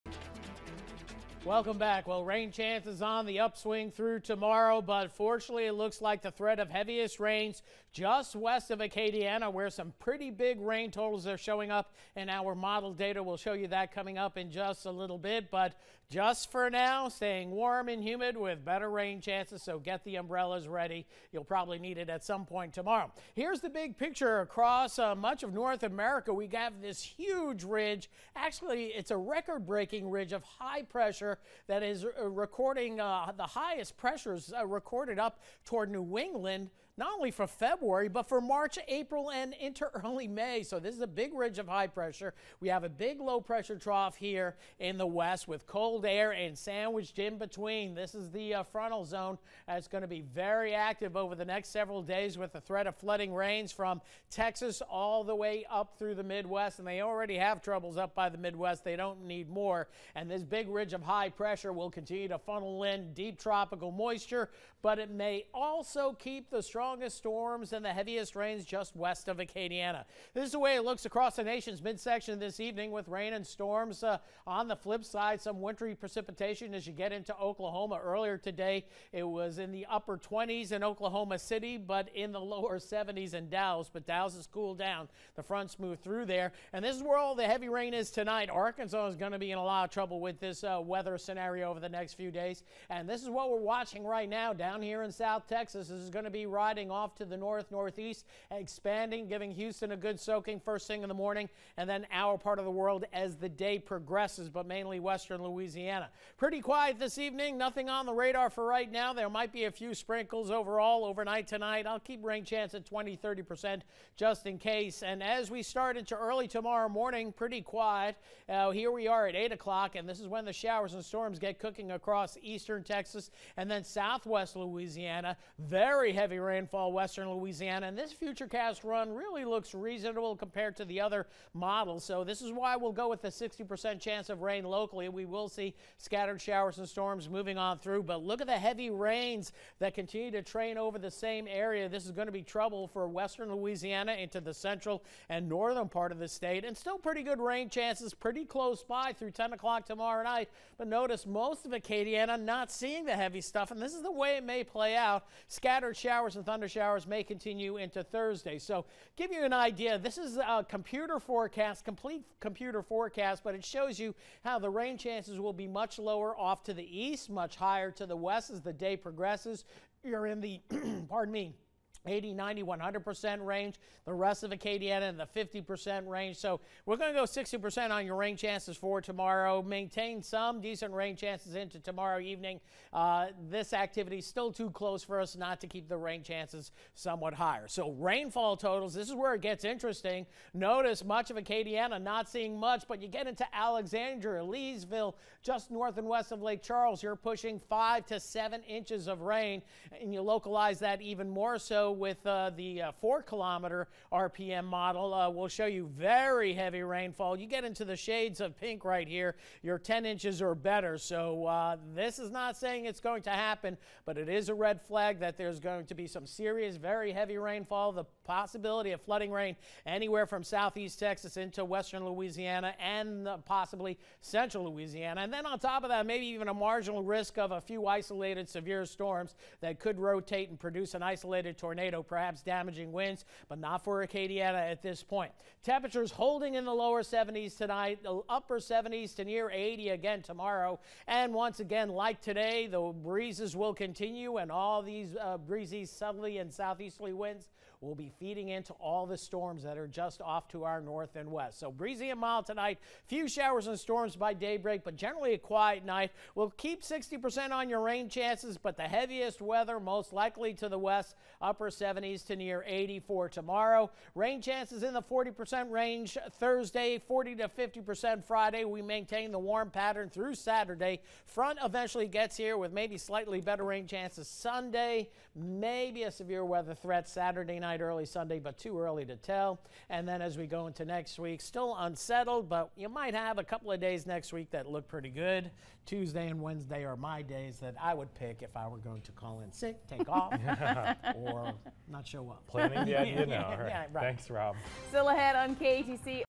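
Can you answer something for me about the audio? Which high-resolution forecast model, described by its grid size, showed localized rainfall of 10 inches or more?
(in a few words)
4 kilometer RPM model.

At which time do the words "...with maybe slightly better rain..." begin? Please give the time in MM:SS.
04:32.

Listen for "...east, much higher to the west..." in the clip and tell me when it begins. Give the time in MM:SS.
02:46.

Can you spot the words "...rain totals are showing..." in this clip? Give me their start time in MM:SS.
00:10.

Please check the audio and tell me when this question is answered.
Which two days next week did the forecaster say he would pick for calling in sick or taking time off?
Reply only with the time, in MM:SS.
04:45.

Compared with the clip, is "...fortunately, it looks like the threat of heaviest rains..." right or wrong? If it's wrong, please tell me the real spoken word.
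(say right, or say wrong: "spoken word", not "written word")
right.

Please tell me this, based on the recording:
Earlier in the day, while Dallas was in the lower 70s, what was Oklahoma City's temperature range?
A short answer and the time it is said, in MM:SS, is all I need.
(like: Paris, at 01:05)
upper 20s, at 01:19.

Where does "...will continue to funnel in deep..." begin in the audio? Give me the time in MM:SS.
01:01.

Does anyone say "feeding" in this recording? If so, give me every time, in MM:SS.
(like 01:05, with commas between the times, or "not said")
04:08.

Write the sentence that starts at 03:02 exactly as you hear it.
Uh, this activity is still too close for us not to keep the rain chances somewhat higher.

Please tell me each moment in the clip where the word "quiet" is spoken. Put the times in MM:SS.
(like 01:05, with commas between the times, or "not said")
01:46, 01:57, 04:15.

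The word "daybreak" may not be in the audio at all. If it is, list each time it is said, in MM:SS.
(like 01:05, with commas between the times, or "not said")
04:14.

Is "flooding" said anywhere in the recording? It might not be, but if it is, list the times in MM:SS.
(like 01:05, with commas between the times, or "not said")
00:52, 03:39.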